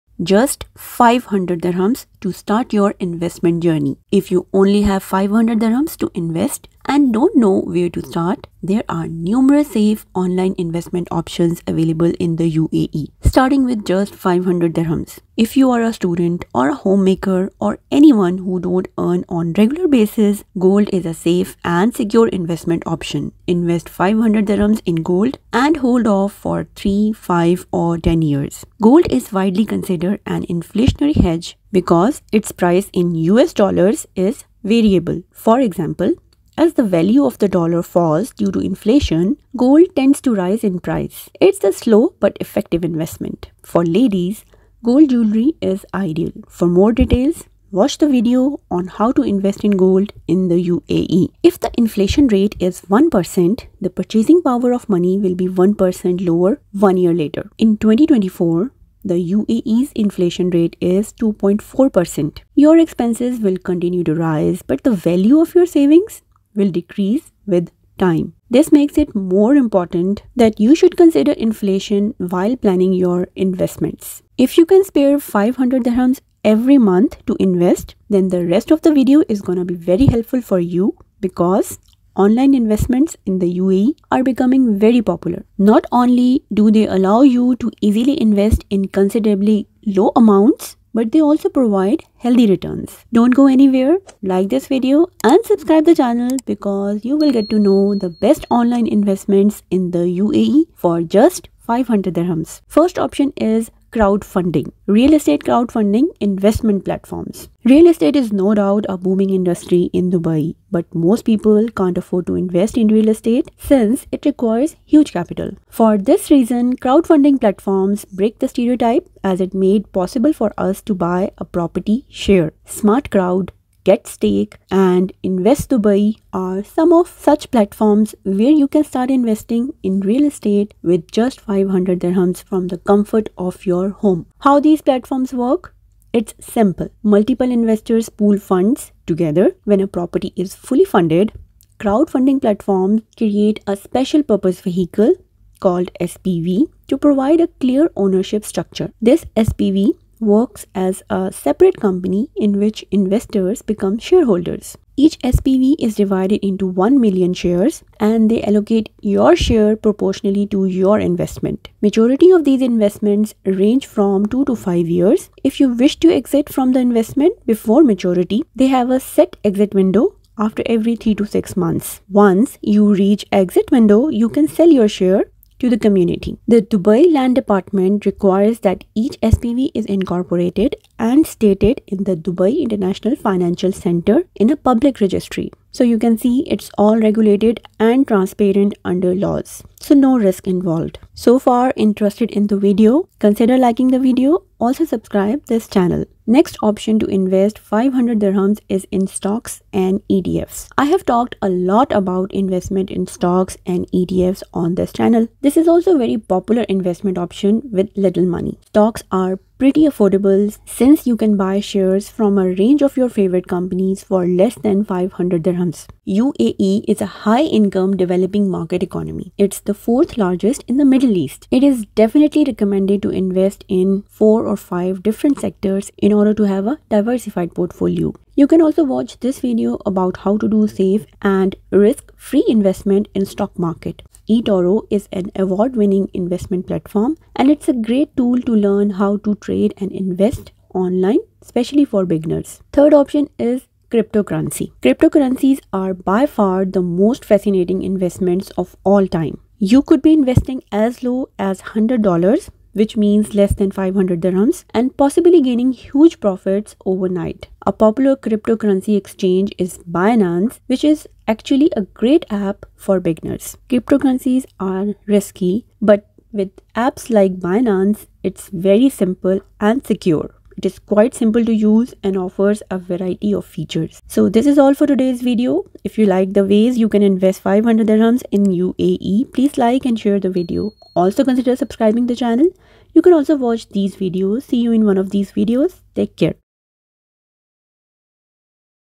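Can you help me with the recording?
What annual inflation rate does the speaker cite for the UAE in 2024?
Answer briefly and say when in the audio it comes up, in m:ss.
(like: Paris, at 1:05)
2.4%, at 1:01.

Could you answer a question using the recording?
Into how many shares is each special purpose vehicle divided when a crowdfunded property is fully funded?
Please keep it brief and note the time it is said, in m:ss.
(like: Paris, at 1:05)
1 million, at 2:36.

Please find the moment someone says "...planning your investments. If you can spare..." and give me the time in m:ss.
1:12.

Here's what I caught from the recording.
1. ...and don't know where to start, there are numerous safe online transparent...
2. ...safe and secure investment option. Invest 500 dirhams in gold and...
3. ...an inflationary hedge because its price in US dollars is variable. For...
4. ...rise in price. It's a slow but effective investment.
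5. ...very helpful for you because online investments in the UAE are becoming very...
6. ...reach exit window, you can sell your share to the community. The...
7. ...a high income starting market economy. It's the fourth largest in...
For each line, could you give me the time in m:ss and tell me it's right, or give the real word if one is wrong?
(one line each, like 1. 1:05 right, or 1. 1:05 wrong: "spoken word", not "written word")
1. 0:06 wrong: "investment", not "transparent"
2. 0:21 right
3. 0:30 right
4. 0:40 right
5. 1:19 right
6. 2:52 right
7. 3:36 wrong: "developing", not "starting".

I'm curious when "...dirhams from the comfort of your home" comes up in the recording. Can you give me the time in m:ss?
2:11.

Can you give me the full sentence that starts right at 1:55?
For this reason, crowdfunding platforms break the stereotype as it made possible for us to buy a property share.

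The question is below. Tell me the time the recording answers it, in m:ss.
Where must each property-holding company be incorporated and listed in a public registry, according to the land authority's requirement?
3:02.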